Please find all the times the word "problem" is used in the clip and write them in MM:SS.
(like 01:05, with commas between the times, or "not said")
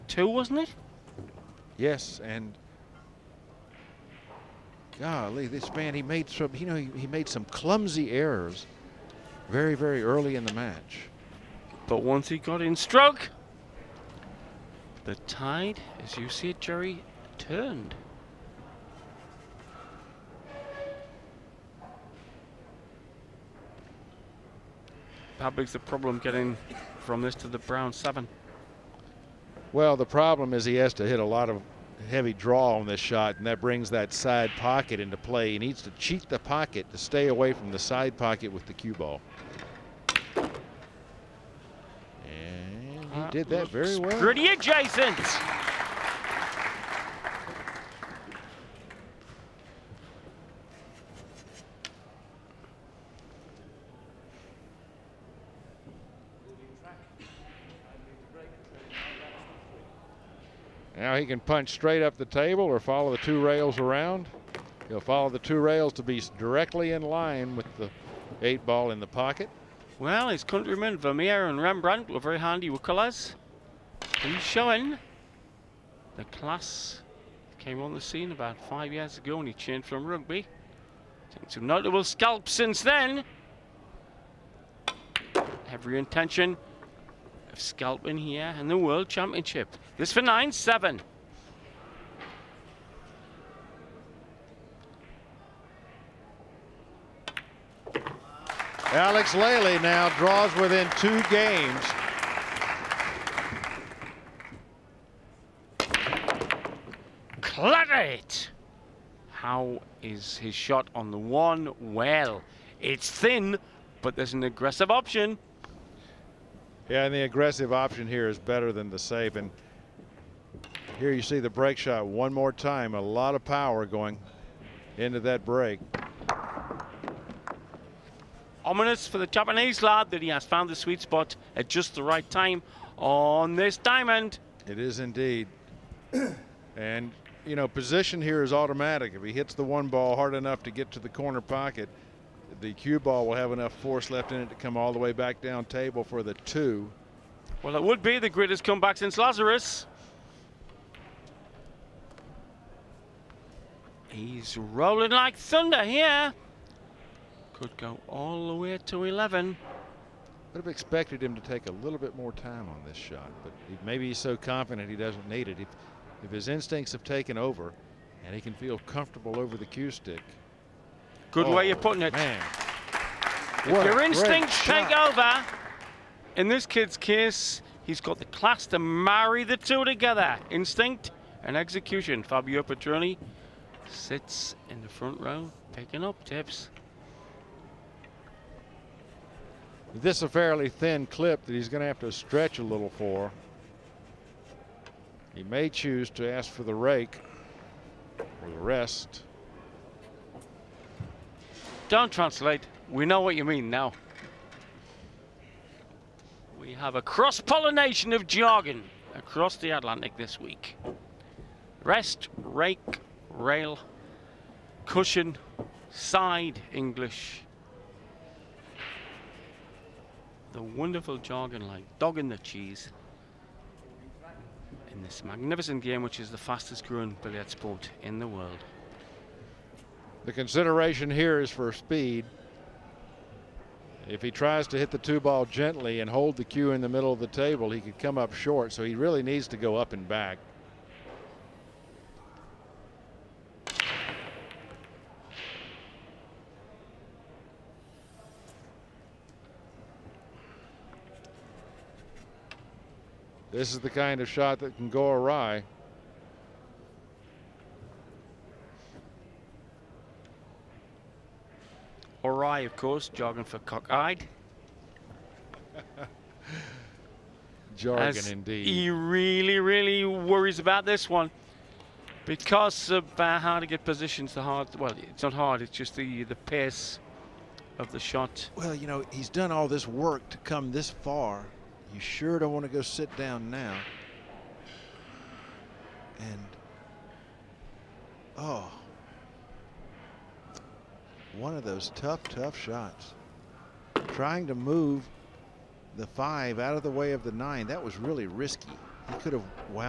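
00:25, 00:30.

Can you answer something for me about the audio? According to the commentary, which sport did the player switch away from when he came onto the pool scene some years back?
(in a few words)
Rugby.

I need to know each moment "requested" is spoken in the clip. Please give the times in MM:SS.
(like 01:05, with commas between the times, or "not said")
not said.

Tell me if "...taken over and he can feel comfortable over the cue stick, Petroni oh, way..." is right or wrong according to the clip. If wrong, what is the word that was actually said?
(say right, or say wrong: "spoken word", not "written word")
wrong: "Good", not "Petroni".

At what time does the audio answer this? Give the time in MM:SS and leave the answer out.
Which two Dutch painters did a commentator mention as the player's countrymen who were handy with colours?
01:10.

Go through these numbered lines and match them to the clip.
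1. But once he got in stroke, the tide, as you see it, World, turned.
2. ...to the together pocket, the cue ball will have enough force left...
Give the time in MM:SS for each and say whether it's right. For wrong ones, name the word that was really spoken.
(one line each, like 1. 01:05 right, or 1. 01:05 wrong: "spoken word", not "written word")
1. 00:11 wrong: "Jerry", not "World"
2. 02:20 wrong: "corner", not "together".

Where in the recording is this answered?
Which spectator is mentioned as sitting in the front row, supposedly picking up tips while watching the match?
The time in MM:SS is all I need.
03:02.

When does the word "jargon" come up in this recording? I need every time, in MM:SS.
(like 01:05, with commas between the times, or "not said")
03:28, 03:41, 04:23, 04:27.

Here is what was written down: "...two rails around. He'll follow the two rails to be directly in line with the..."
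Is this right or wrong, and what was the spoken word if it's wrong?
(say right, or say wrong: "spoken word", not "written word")
right.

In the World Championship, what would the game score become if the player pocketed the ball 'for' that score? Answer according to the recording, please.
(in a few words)
9-7.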